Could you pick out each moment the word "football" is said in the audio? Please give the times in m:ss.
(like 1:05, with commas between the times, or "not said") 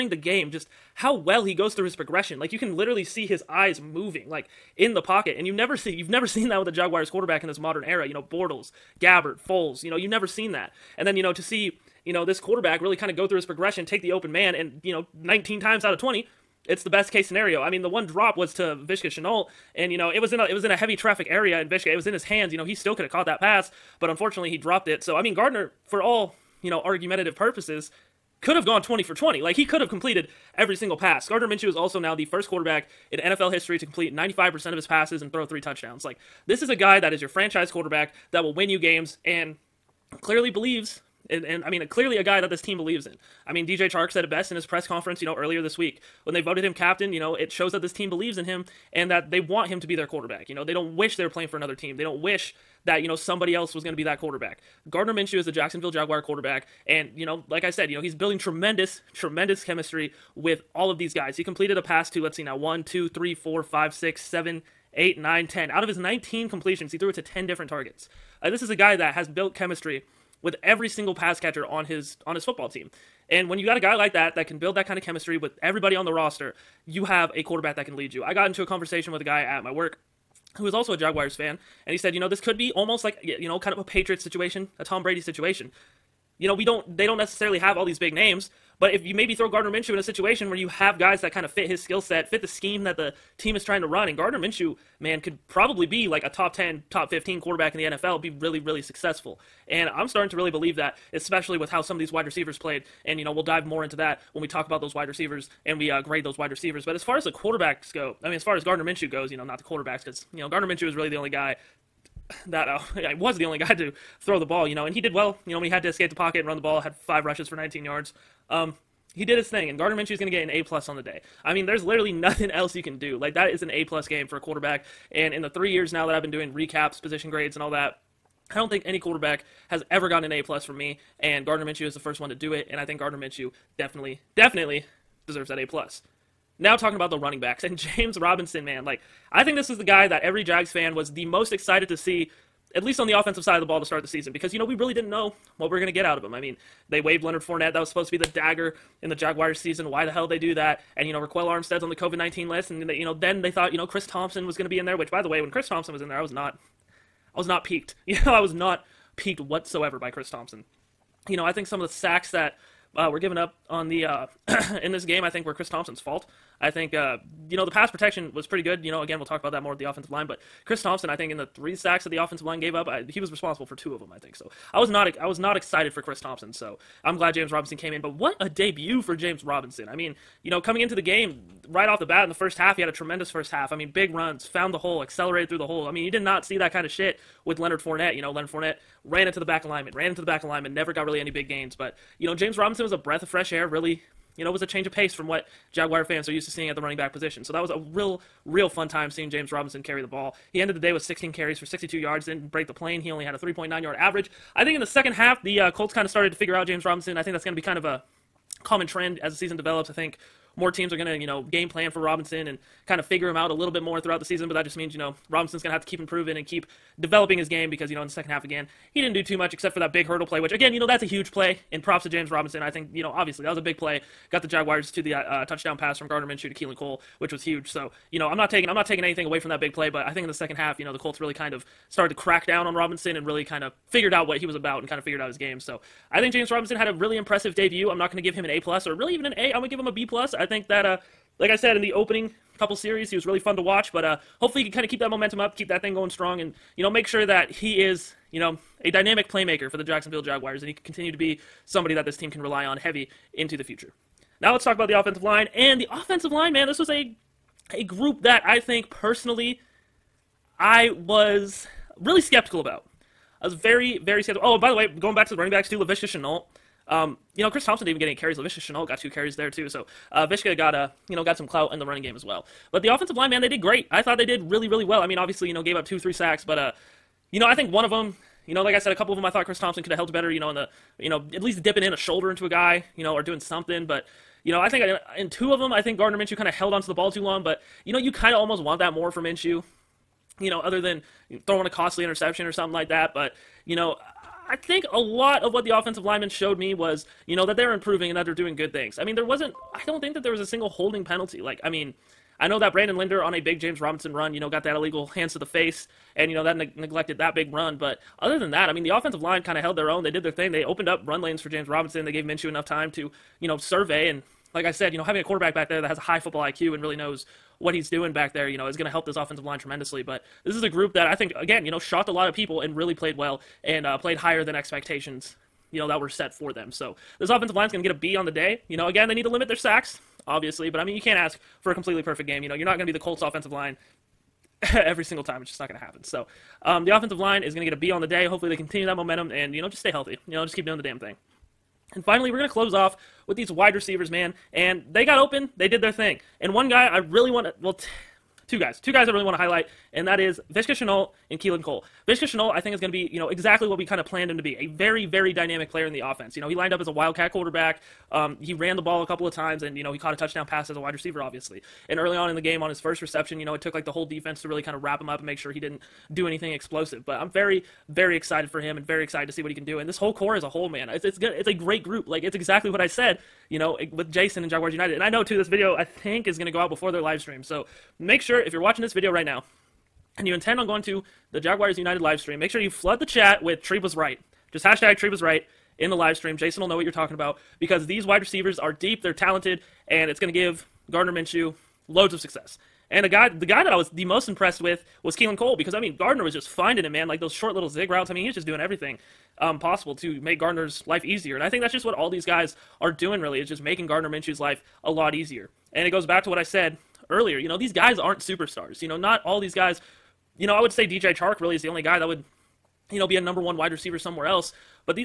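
1:12, 5:16.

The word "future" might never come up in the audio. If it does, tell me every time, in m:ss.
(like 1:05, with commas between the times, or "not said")
4:13.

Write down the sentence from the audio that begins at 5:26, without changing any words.
So this offensive line's going to get a B on the day.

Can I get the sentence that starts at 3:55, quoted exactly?
So, I think James Robinson had a really impressive debut.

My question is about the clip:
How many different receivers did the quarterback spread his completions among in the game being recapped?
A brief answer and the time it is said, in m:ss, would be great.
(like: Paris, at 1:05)
10, at 1:07.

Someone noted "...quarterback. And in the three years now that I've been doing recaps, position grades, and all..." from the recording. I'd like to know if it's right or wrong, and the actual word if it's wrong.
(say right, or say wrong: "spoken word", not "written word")
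right.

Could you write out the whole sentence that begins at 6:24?
Just hashtag Treeb was right in the live stream.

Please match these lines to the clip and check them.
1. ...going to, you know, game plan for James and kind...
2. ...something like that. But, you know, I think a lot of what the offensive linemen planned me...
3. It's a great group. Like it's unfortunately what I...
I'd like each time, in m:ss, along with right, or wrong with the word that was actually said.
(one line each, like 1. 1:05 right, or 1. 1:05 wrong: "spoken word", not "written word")
1. 3:30 wrong: "Robinson", not "James"
2. 4:52 wrong: "showed", not "planned"
3. 6:11 wrong: "exactly", not "unfortunately".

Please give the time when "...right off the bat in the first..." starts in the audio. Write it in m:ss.
3:01.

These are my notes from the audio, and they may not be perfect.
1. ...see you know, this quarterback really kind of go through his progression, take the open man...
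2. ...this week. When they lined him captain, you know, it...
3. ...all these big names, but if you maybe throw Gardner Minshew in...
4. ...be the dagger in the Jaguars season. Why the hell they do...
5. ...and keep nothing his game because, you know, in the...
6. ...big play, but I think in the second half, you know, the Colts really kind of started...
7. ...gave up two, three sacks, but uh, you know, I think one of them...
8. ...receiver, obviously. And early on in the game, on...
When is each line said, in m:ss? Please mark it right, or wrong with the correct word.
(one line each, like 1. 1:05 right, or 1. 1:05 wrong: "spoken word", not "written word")
1. 0:11 right
2. 0:45 wrong: "voted", not "lined"
3. 1:27 right
4. 2:28 right
5. 3:36 wrong: "developing", not "nothing"
6. 3:49 right
7. 4:35 right
8. 6:00 right.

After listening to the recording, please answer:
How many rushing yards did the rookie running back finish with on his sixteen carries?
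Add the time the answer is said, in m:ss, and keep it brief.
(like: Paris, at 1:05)
62, at 3:21.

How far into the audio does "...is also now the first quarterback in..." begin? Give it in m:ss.
0:31.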